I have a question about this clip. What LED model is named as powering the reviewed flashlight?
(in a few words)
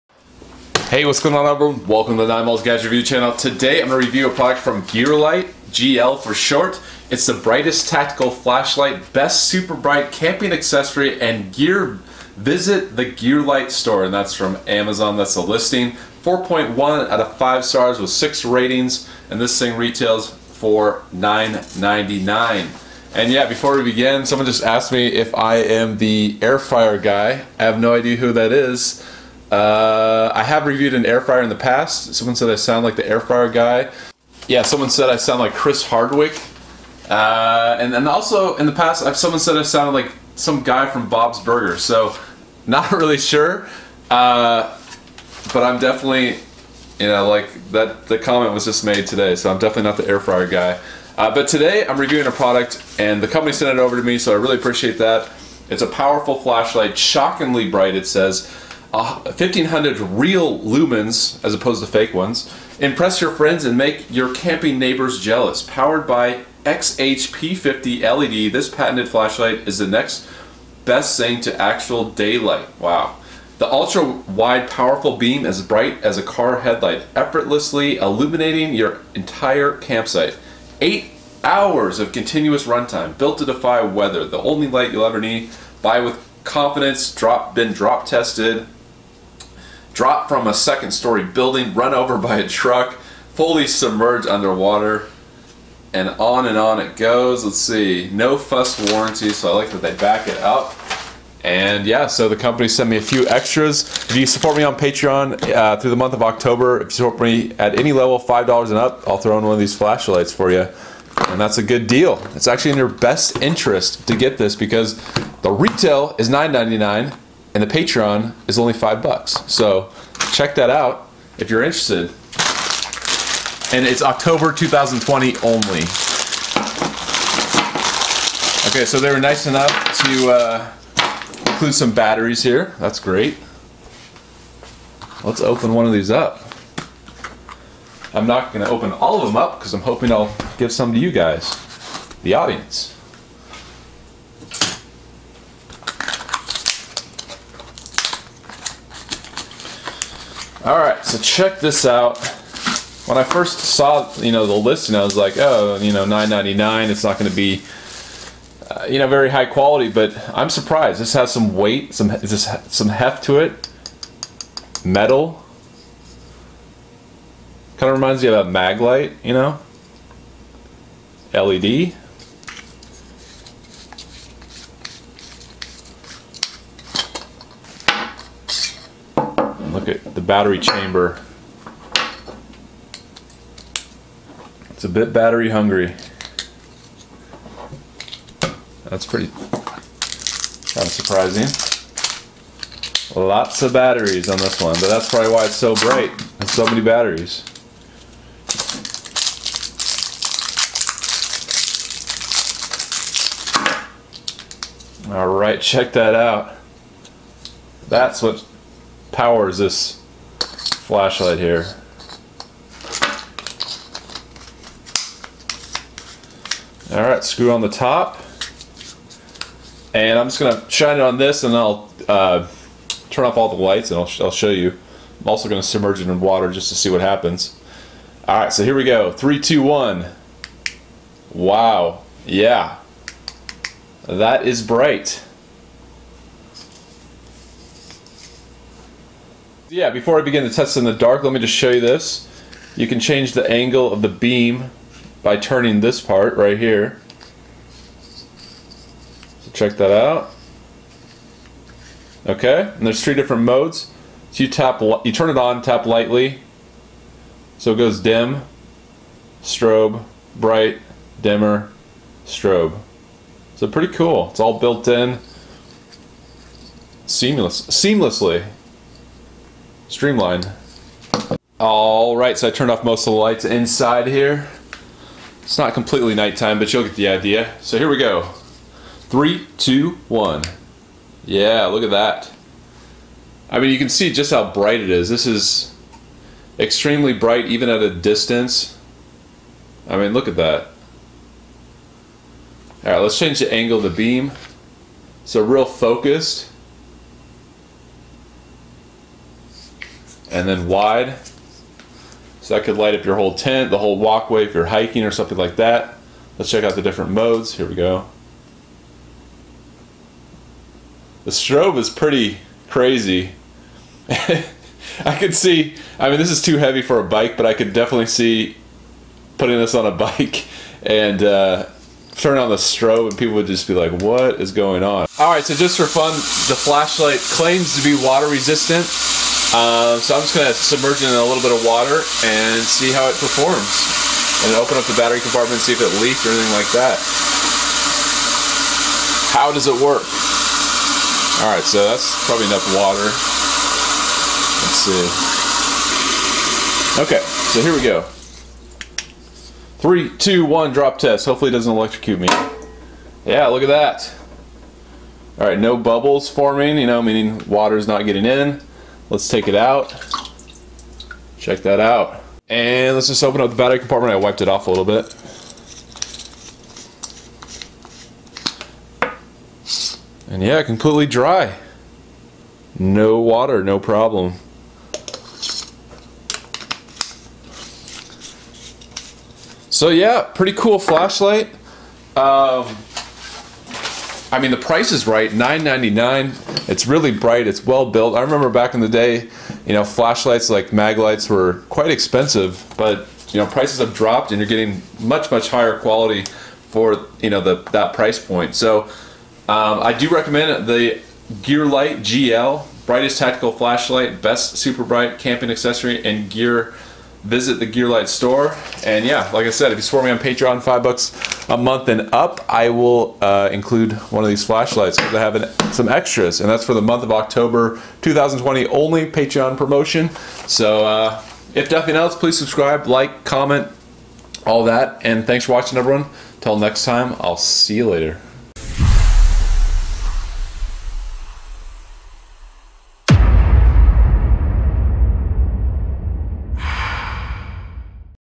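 XHP50.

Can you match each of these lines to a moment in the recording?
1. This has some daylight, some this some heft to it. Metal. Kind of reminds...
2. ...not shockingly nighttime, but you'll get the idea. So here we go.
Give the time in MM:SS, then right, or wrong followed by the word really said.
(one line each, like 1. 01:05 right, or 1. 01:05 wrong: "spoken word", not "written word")
1. 02:41 wrong: "weight", not "daylight"
2. 04:35 wrong: "completely", not "shockingly".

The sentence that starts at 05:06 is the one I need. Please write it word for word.
Let's check out the different modes.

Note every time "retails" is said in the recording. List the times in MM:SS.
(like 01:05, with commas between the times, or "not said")
00:19, 01:55.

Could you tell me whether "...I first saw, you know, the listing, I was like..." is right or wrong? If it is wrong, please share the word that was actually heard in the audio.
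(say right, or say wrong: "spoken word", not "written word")
right.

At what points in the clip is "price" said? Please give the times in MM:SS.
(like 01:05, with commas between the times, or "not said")
06:24, 06:33, 06:37.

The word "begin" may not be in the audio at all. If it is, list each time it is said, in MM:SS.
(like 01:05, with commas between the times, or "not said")
00:23, 04:00.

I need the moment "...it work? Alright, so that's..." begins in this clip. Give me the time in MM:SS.
05:39.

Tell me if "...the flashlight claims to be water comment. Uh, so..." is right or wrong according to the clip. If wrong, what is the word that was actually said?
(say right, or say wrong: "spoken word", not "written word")
wrong: "resistant", not "comment".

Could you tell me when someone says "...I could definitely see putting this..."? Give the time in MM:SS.
05:17.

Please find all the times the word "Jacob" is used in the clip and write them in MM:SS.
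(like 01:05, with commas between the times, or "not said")
not said.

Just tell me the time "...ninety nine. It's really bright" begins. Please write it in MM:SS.
06:25.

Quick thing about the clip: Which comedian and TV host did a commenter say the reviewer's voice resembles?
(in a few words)
Chris Hardwick.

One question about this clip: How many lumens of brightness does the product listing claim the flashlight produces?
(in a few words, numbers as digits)
1500.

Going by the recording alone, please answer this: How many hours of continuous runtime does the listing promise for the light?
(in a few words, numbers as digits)
8.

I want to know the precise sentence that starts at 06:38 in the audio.
So um, I do recommend the Gear Light GL, brightest tactical flashlight, best super bright camping accessory, and gear.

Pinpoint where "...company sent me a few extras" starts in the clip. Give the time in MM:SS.
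01:42.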